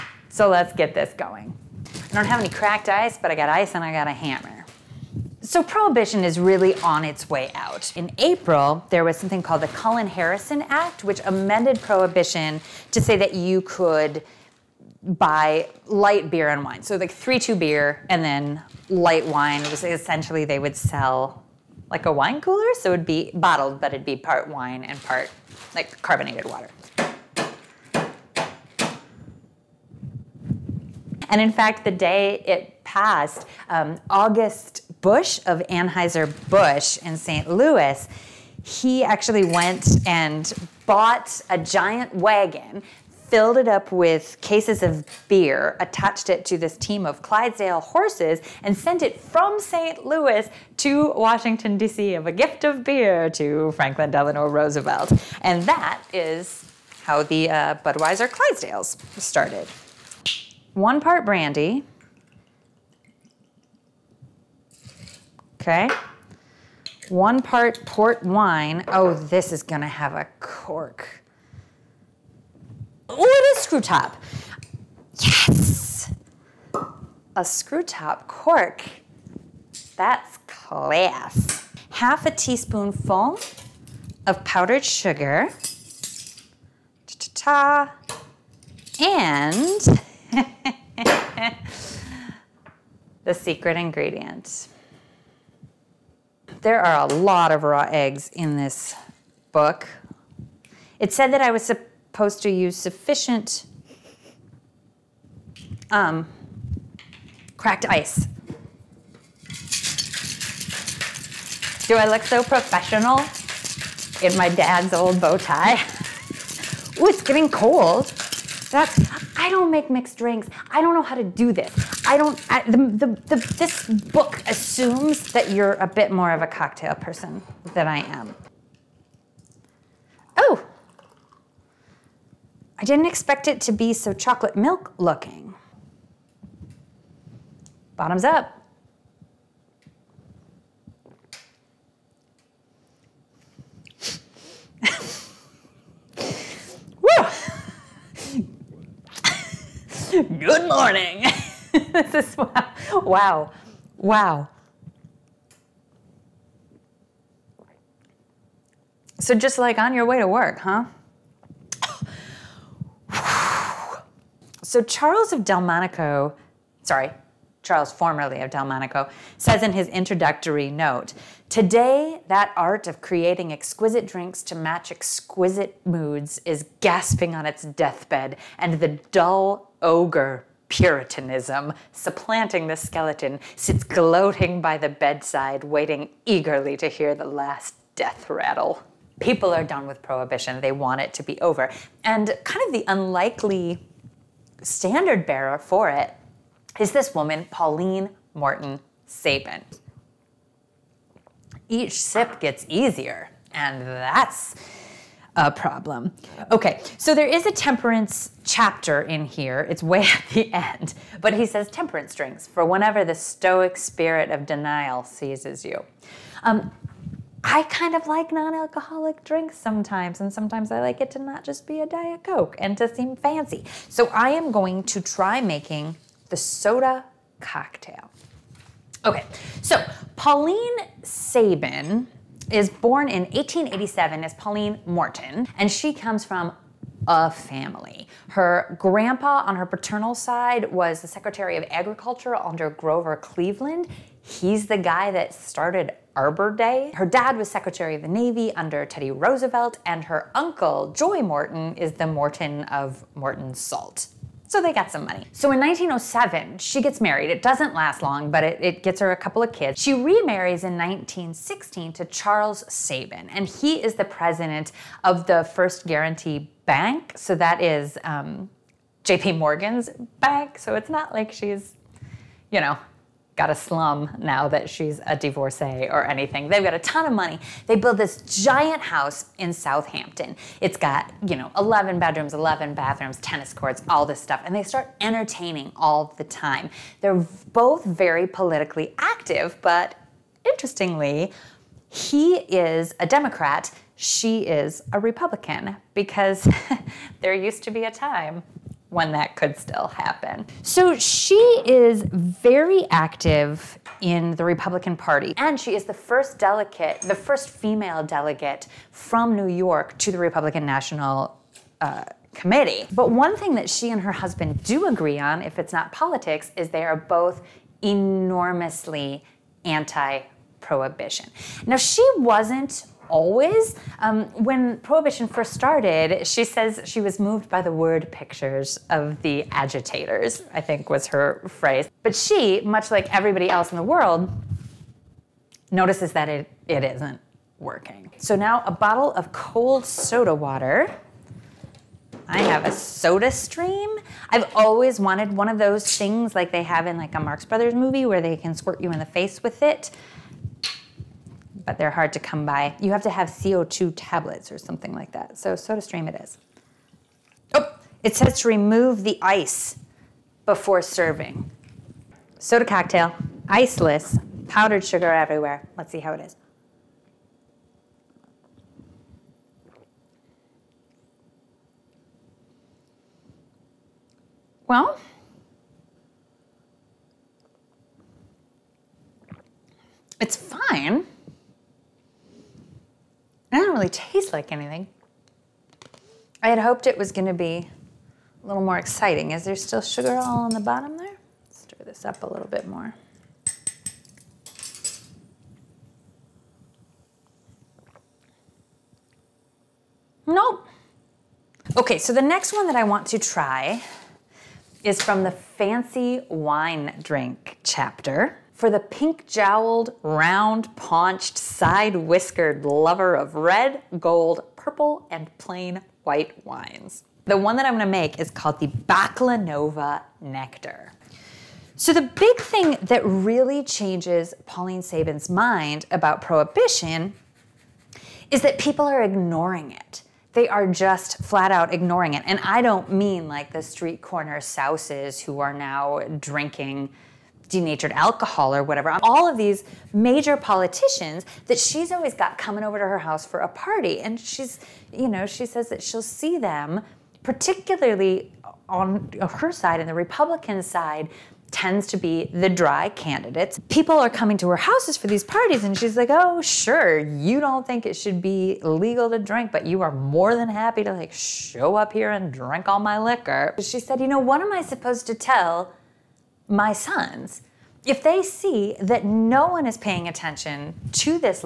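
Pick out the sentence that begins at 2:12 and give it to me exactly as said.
I didn't expect it to be so chocolate milk looking.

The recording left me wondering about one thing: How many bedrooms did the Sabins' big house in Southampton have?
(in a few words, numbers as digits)
11.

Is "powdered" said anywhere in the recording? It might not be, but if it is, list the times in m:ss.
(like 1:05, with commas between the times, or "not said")
1:24, 6:04.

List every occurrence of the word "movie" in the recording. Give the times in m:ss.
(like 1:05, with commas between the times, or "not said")
5:47.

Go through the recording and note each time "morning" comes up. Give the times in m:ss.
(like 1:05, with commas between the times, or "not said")
2:30.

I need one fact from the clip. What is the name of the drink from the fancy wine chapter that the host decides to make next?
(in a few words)
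Baklanova Nectar.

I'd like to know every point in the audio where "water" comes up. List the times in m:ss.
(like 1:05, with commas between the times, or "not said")
0:26, 5:40.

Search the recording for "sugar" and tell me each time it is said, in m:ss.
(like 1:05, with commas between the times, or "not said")
1:24, 6:04, 6:29.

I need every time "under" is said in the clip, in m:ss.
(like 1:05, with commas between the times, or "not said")
4:02, 4:08.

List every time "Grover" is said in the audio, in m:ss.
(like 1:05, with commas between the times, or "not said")
4:02.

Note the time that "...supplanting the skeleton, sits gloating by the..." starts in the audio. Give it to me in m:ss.
3:01.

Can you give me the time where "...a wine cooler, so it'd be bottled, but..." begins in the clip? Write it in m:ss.
0:22.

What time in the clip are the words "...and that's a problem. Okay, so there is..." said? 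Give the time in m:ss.
3:23.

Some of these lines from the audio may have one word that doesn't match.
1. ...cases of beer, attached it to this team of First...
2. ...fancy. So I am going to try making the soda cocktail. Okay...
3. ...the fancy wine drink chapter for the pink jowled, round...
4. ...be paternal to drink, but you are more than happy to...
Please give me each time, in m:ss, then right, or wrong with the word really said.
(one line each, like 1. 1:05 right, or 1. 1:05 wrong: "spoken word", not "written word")
1. 0:44 wrong: "Clydesdale", not "First"
2. 3:43 right
3. 6:45 right
4. 7:38 wrong: "legal", not "paternal".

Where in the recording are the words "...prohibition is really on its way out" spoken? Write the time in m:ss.
0:05.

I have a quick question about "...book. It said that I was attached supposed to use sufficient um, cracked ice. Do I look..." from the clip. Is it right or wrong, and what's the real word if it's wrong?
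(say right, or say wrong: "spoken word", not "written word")
wrong: "supposed", not "attached".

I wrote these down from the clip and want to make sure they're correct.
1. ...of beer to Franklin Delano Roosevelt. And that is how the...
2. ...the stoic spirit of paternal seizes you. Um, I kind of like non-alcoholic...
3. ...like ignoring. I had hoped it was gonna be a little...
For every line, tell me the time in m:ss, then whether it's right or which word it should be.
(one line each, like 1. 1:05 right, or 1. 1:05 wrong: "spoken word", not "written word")
1. 0:52 right
2. 3:33 wrong: "denial", not "paternal"
3. 6:24 wrong: "anything", not "ignoring".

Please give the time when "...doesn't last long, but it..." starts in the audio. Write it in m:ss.
4:17.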